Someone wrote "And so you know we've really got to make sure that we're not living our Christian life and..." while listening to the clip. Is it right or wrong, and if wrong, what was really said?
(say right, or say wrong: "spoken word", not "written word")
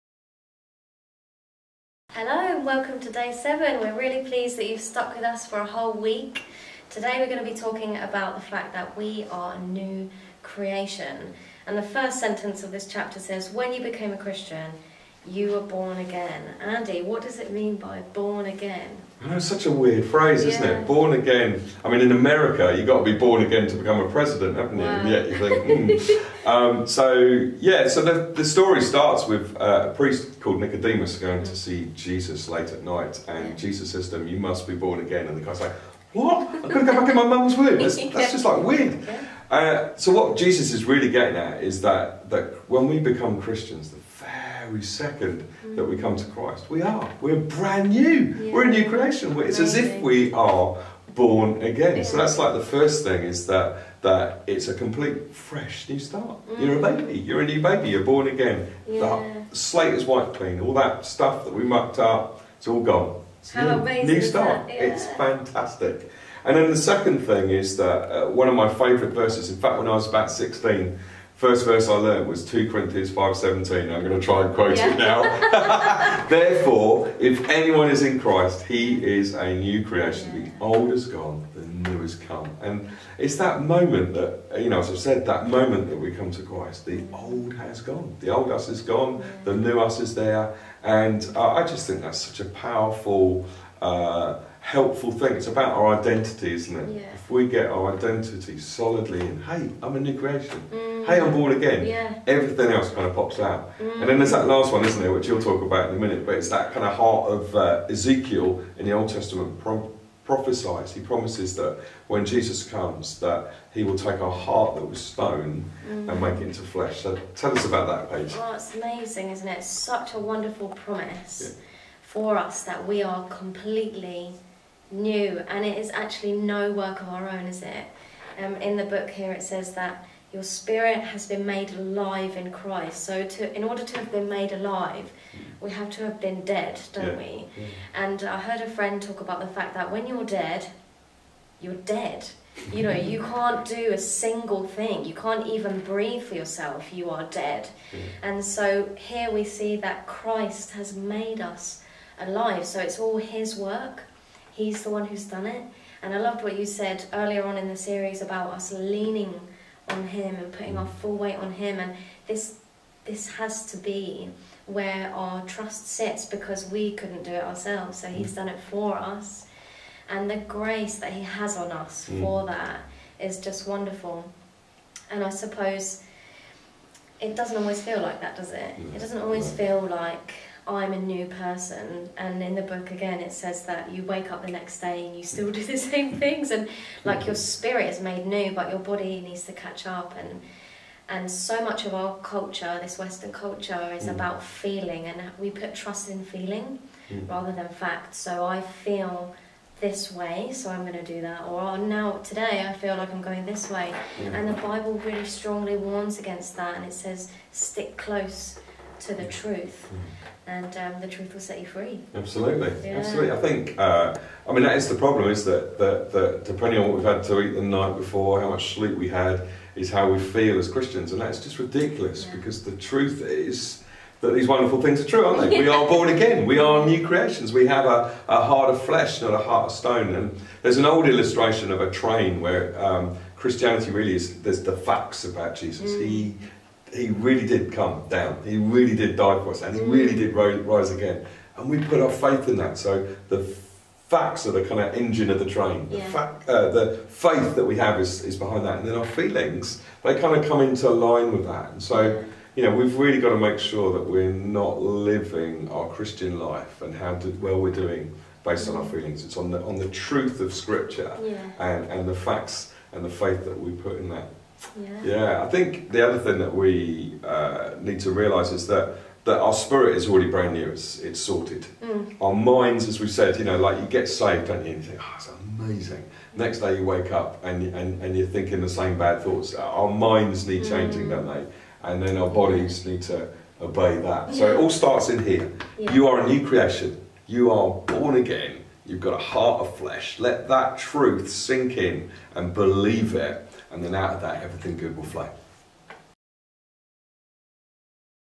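right.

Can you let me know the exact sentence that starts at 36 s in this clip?
I could go back in my mum's womb.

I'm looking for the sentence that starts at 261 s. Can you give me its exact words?
and and the facts and the faith that we put in that.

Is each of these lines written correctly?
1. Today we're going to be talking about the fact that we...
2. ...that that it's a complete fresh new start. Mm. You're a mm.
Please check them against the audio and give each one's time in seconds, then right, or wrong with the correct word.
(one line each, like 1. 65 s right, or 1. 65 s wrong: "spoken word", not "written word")
1. 6 s right
2. 53 s right.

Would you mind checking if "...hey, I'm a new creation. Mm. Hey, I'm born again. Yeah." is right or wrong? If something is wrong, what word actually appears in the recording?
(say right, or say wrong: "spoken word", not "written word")
right.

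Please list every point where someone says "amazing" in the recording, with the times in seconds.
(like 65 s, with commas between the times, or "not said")
49 s, 63 s, 118 s, 275 s.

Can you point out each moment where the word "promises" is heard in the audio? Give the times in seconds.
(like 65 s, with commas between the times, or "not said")
111 s, 120 s.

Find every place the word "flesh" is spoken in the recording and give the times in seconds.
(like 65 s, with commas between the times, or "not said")
116 s, 228 s, 289 s.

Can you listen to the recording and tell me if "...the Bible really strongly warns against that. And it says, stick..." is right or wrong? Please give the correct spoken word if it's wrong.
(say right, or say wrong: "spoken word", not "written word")
right.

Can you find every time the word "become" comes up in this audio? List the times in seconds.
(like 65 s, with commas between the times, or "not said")
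23 s, 42 s.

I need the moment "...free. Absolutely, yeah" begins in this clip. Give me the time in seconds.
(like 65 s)
211 s.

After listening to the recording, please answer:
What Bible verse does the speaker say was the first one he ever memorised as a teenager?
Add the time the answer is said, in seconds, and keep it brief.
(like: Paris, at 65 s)
2 Corinthians 5:17, at 72 s.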